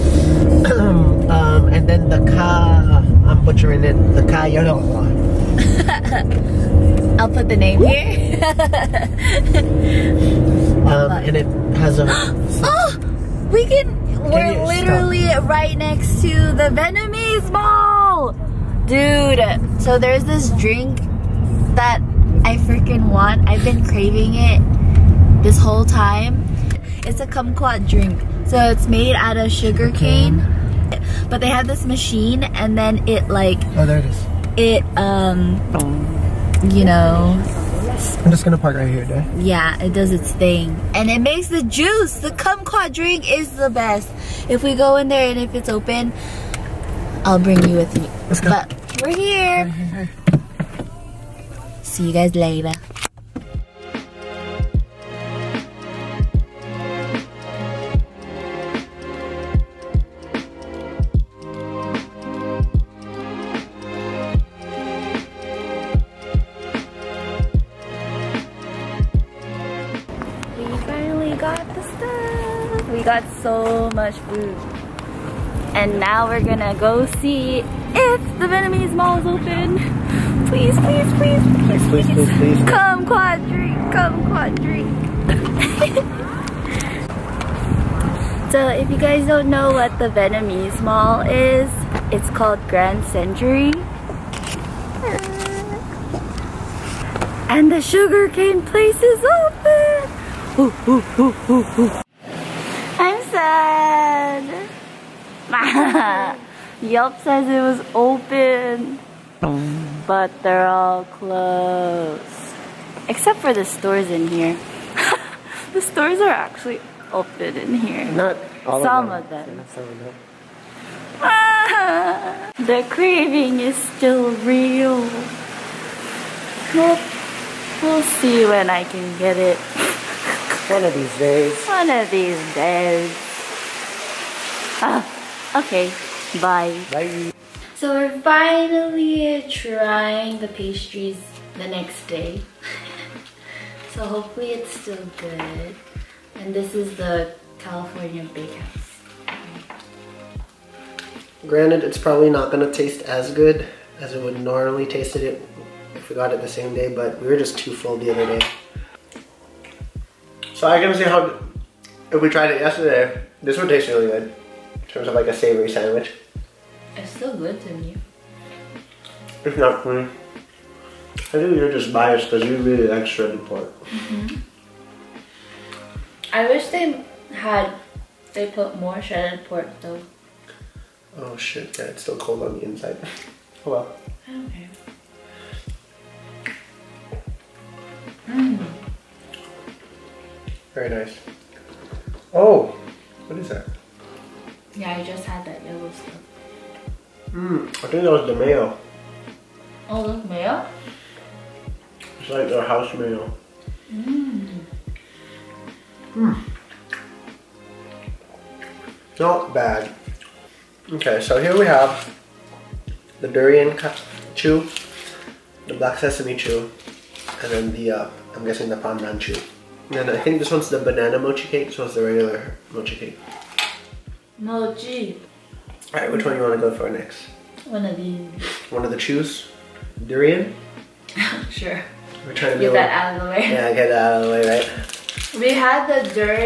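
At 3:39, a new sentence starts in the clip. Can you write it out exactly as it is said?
And I think this one's the banana mochi cake, this one's the regular mochi cake.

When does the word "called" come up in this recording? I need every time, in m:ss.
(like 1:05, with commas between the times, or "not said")
1:32.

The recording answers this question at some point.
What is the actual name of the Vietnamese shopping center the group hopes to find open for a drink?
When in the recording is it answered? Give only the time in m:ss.
1:32.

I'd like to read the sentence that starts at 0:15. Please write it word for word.
right next to the Vietnamese Mall, dude.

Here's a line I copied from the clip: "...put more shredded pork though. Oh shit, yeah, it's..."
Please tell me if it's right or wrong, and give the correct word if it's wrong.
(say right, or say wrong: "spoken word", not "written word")
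right.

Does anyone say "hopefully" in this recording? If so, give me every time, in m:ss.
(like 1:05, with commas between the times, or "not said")
2:24.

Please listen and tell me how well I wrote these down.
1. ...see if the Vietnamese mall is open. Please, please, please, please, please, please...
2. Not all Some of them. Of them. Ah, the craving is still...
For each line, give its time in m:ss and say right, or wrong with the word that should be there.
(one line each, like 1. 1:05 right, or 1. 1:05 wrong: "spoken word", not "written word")
1. 1:17 right
2. 1:58 right.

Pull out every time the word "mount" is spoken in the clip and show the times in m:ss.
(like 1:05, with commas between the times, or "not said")
not said.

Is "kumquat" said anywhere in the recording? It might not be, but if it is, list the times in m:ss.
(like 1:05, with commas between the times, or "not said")
0:27, 0:42.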